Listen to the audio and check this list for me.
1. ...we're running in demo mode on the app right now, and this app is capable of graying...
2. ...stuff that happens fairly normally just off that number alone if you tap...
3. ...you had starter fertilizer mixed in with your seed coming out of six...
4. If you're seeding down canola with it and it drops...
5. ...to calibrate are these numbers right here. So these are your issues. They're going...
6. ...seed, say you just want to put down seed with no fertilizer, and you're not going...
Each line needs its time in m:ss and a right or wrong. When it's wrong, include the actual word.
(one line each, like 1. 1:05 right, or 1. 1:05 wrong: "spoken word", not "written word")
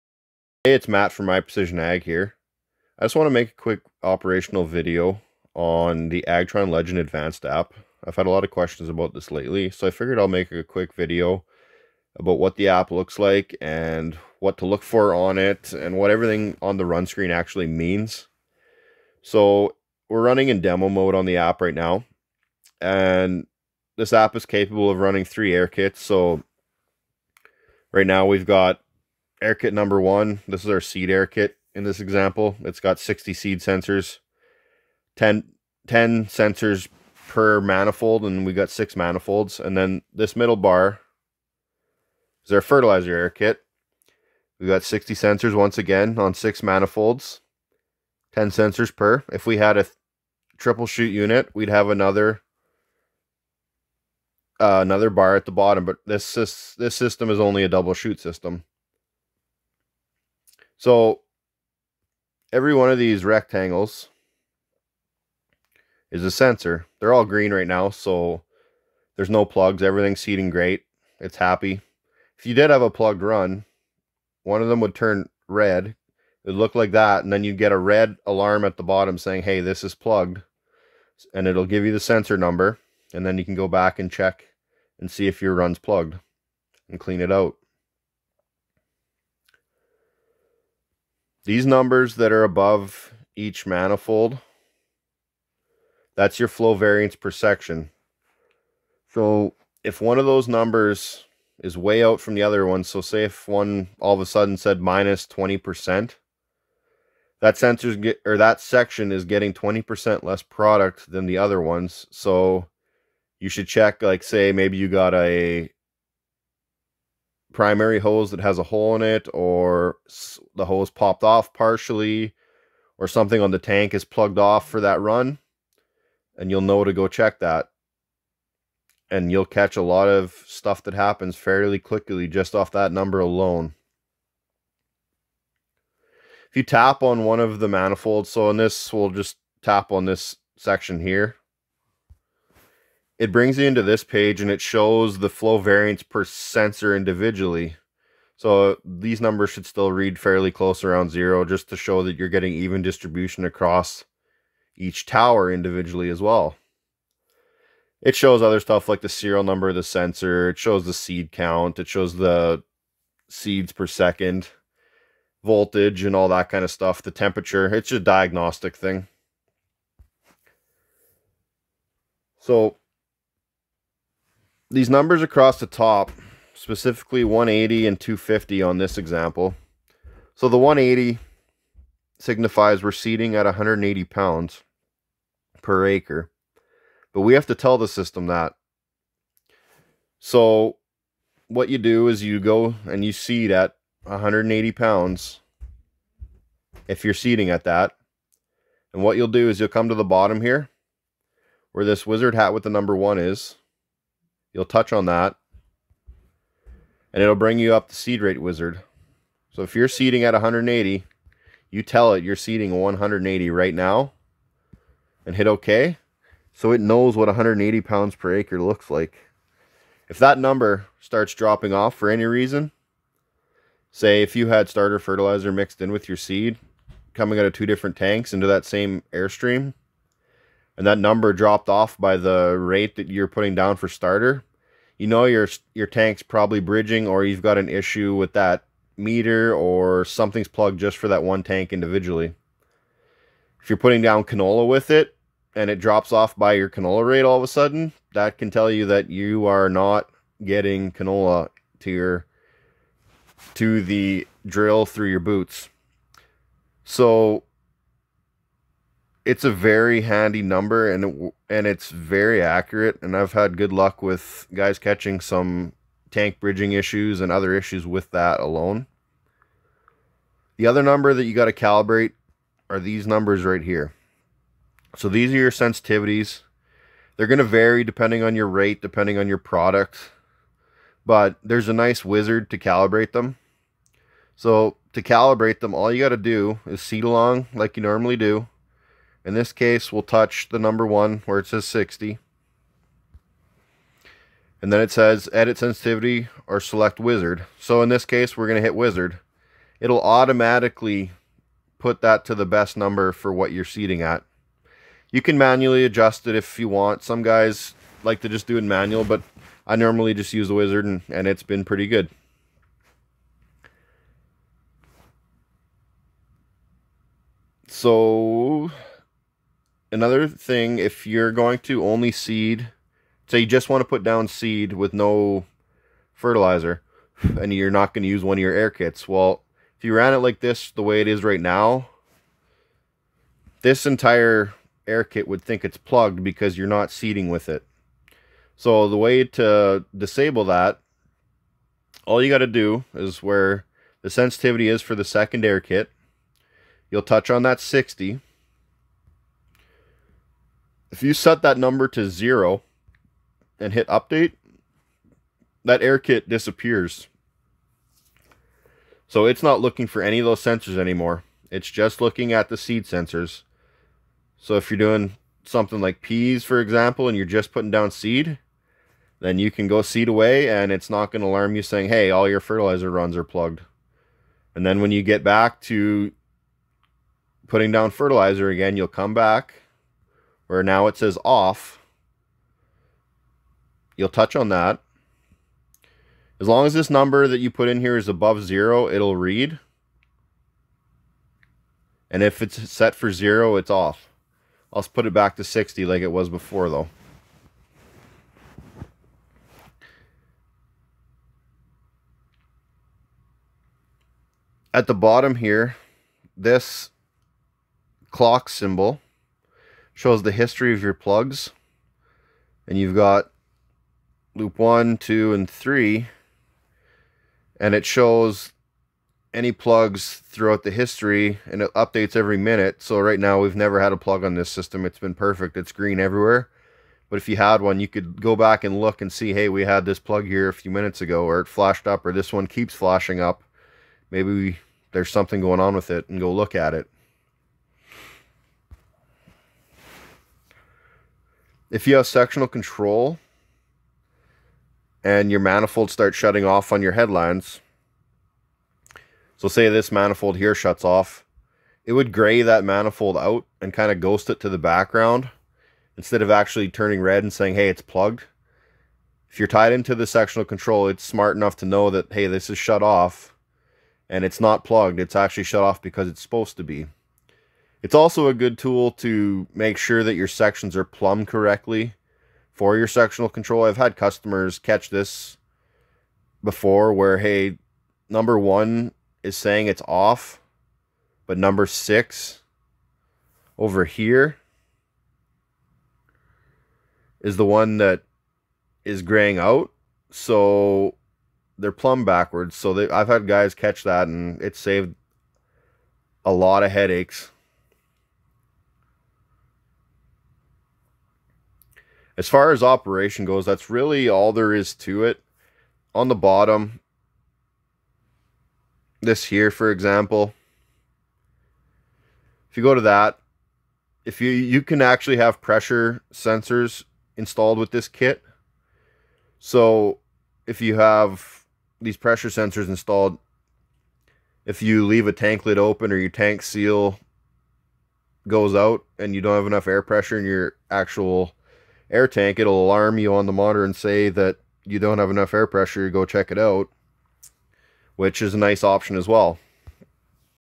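1. 0:20 wrong: "running", not "graying"
2. 2:10 wrong: "quickly", not "normally"
3. 3:44 wrong: "two", not "six"
4. 4:03 wrong: "putting", not "seeding"
5. 4:31 wrong: "sensitivities", not "issues"
6. 5:22 right.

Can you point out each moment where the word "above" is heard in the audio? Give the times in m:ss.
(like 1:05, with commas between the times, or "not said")
1:32, 6:28.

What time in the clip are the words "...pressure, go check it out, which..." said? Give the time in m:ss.
8:55.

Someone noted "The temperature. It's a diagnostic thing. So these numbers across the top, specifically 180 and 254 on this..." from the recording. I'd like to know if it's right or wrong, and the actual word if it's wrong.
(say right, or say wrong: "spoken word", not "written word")
wrong: "250", not "254".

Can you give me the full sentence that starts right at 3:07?
But we have to tell the system that.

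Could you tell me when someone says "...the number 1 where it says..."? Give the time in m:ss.
4:50.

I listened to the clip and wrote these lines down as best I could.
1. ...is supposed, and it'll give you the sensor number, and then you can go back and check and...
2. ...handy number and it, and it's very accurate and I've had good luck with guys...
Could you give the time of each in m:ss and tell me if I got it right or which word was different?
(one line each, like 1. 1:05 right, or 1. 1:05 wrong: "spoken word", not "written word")
1. 1:19 wrong: "plugged", not "supposed"
2. 4:20 right.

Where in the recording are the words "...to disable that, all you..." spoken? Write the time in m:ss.
5:39.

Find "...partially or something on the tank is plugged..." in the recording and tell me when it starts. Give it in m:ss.
2:01.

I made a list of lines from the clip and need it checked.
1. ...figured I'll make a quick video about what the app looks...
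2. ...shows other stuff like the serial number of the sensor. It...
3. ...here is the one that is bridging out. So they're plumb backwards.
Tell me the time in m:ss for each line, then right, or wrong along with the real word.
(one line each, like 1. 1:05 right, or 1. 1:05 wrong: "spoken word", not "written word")
1. 0:09 right
2. 2:38 right
3. 8:03 wrong: "graying", not "bridging".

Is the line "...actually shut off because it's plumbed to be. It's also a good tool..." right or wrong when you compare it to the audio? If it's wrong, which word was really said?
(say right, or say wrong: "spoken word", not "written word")
wrong: "supposed", not "plumbed".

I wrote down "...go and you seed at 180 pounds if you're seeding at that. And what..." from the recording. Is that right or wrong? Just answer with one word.
right.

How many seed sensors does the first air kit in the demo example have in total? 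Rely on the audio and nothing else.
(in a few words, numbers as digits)
60.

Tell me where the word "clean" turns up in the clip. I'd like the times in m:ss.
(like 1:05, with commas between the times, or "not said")
1:26.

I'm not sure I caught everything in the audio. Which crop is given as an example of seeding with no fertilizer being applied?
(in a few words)
Peas.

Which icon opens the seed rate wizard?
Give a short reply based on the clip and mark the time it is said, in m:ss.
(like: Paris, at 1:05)
Wizard hat, at 3:22.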